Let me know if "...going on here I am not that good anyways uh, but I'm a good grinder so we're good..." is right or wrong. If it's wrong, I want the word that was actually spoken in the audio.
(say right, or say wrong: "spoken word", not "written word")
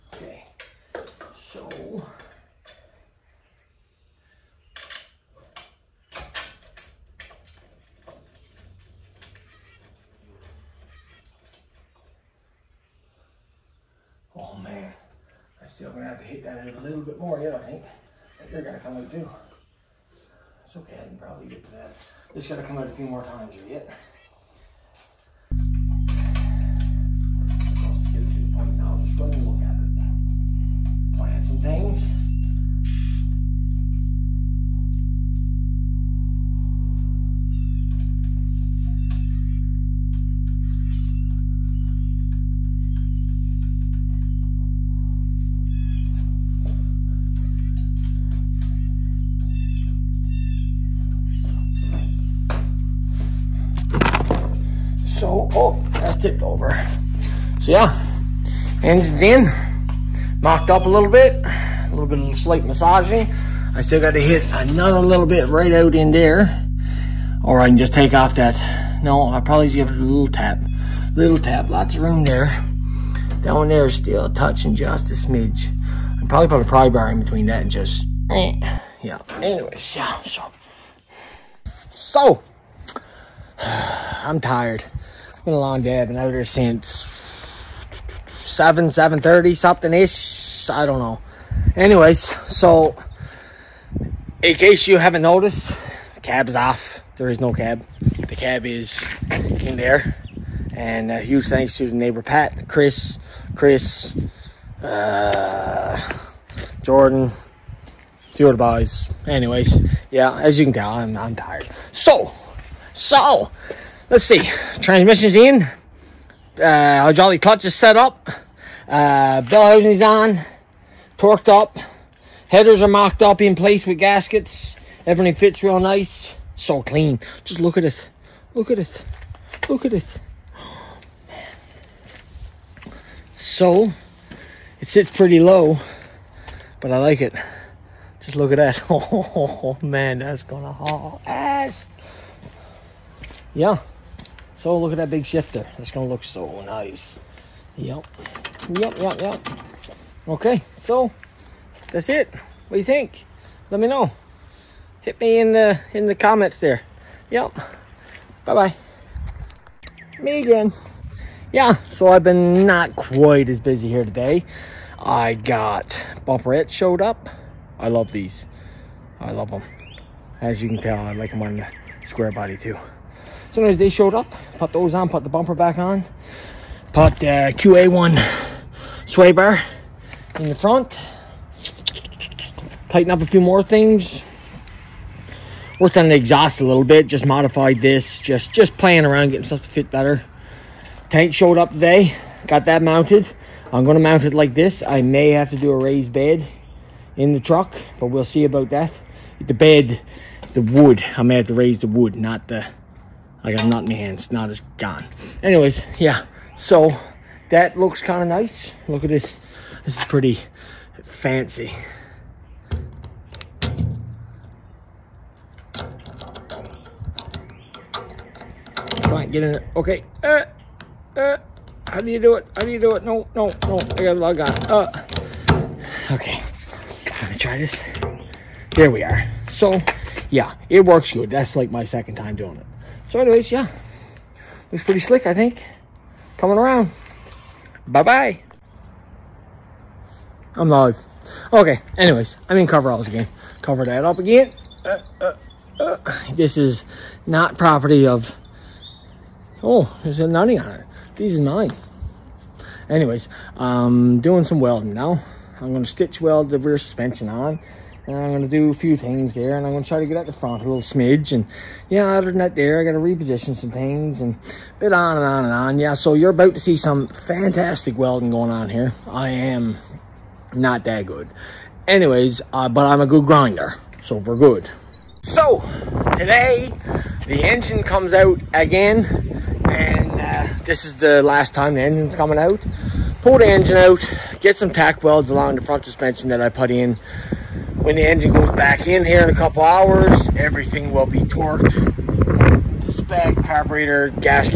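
right.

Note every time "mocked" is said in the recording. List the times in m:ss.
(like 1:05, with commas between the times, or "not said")
1:00, 2:02.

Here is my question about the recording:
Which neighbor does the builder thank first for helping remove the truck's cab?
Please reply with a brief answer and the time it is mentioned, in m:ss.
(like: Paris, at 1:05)
Pat, at 1:42.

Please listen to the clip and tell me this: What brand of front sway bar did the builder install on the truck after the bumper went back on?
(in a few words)
QA1.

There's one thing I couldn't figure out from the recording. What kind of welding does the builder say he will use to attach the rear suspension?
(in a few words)
Stitch weld.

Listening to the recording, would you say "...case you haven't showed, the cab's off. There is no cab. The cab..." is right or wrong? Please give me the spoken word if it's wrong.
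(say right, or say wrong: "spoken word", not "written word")
wrong: "noticed", not "showed".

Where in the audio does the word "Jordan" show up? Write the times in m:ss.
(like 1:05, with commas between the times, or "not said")
1:46.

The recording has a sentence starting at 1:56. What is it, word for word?
Uh, our jolly clutch is set up.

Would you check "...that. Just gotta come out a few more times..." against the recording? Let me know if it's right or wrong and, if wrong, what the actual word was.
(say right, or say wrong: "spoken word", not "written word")
right.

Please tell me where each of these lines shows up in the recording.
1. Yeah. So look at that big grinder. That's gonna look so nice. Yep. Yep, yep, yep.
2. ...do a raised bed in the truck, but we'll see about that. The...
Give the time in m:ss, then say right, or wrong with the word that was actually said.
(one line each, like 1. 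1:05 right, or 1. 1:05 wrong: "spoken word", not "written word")
1. 2:23 wrong: "shifter", not "grinder"
2. 3:15 right.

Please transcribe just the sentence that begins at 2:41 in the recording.
Yeah, so I've been not quite as busy here today.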